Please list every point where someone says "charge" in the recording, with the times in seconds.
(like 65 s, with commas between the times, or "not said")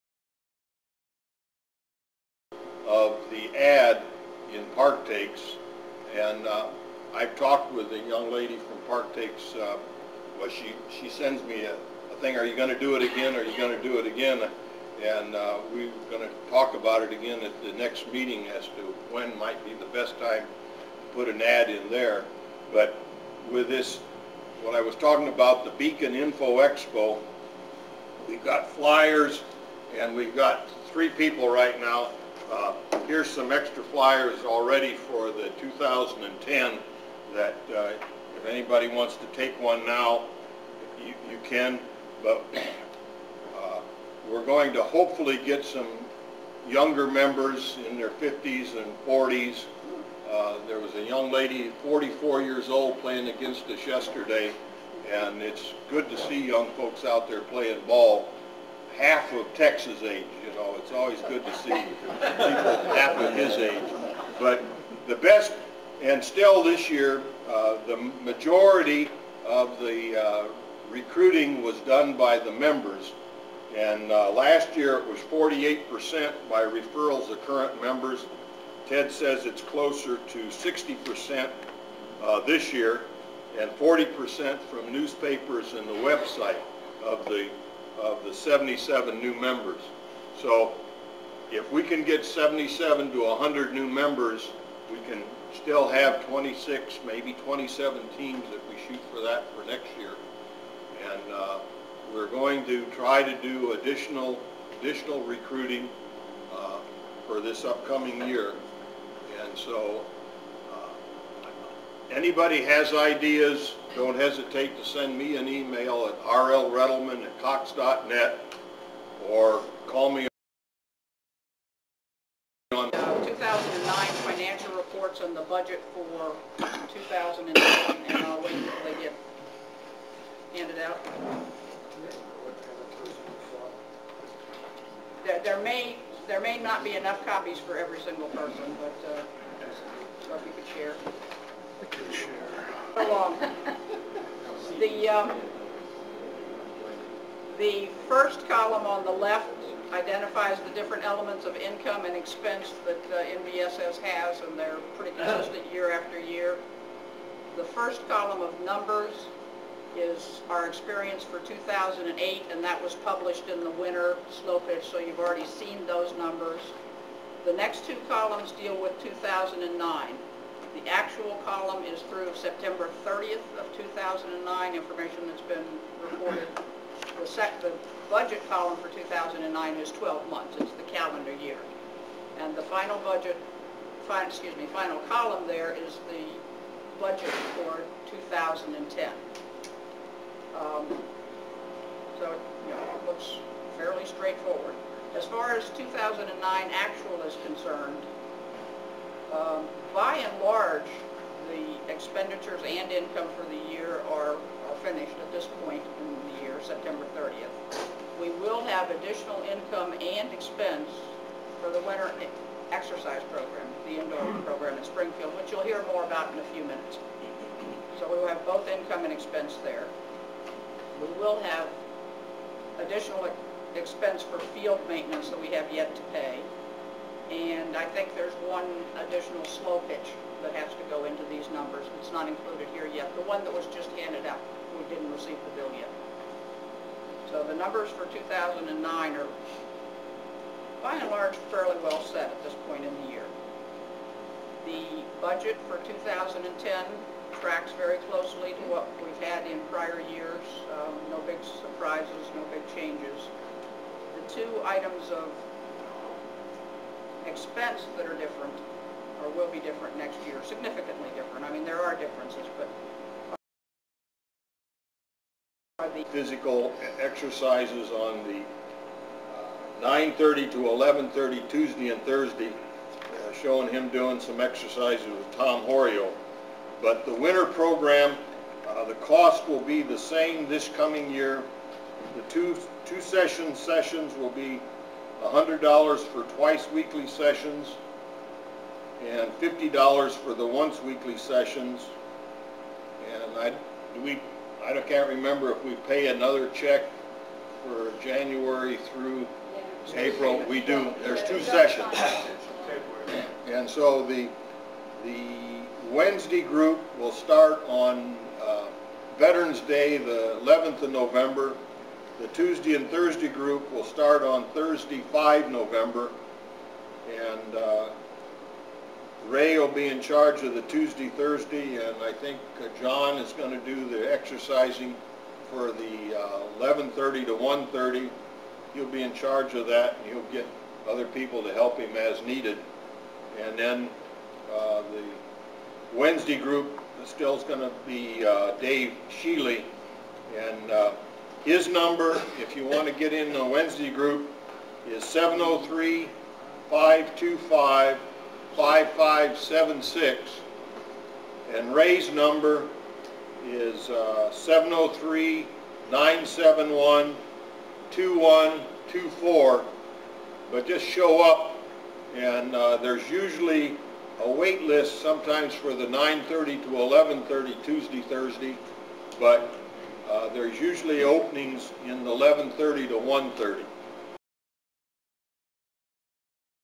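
320 s, 329 s.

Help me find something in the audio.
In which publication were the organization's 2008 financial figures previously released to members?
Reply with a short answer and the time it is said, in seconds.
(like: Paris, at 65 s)
winter snowfish, at 163 s.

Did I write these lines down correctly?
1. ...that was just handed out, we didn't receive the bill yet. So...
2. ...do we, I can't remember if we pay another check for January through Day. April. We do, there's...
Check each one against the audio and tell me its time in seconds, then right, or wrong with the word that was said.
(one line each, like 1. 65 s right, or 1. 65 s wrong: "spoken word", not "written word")
1. 233 s right
2. 293 s wrong: "Yeah", not "Day".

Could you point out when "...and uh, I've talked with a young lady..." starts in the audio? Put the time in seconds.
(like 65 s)
6 s.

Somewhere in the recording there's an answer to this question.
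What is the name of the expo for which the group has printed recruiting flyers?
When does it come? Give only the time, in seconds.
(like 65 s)
25 s.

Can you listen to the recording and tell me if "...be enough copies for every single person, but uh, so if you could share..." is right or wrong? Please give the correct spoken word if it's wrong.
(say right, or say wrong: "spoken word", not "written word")
right.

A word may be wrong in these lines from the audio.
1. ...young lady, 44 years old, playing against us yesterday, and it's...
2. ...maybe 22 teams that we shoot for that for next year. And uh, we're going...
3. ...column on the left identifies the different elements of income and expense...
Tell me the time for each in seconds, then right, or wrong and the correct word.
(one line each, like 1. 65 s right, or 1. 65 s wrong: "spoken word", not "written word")
1. 51 s right
2. 97 s wrong: "27", not "22"
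3. 148 s right.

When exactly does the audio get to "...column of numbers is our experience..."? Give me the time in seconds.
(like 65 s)
158 s.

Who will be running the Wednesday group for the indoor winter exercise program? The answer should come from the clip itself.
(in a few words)
Dave Sheely.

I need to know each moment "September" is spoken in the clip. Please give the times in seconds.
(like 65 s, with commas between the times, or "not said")
172 s, 206 s.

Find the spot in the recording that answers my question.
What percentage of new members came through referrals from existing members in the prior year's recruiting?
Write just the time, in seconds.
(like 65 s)
75 s.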